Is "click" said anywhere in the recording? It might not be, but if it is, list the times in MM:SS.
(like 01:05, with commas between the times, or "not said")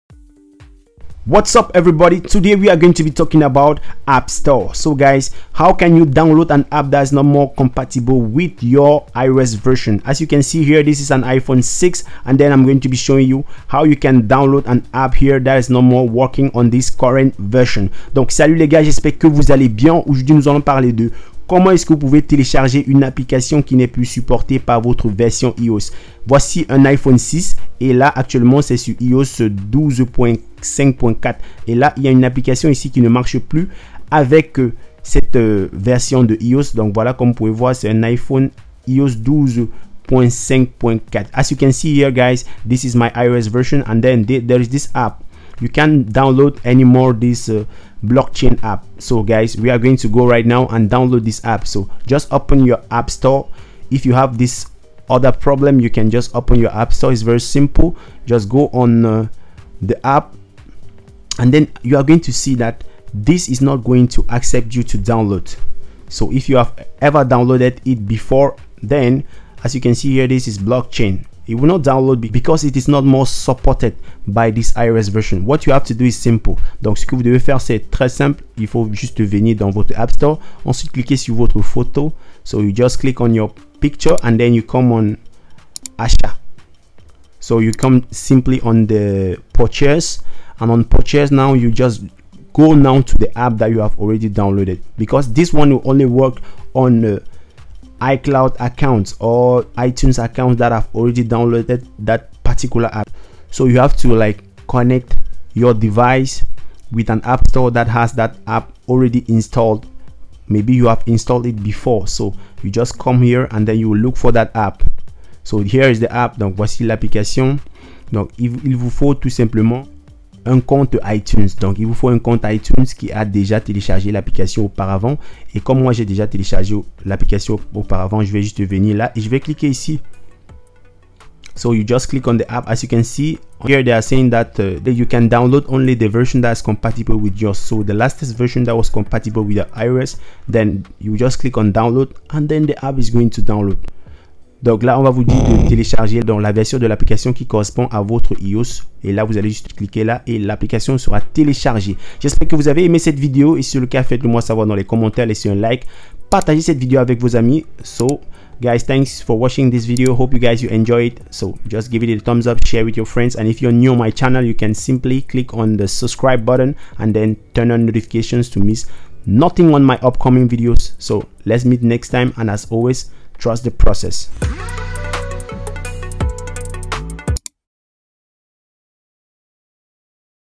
01:22, 02:12, 02:21, 02:45.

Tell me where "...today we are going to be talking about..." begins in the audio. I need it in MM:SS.
00:02.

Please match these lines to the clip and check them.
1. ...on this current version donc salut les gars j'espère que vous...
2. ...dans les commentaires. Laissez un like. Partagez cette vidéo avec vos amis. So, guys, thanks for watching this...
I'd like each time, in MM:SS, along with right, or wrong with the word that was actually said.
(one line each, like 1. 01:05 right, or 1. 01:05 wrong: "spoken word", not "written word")
1. 00:16 right
2. 02:34 right.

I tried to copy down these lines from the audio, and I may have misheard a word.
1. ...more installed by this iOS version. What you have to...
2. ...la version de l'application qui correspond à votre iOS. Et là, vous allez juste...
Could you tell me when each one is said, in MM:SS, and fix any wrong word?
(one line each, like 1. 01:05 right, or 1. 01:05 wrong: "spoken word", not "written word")
1. 01:13 wrong: "supported", not "installed"
2. 02:26 right.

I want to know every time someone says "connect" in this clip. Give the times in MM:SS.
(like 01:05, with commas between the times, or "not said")
01:44.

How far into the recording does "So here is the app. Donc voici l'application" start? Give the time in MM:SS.
01:55.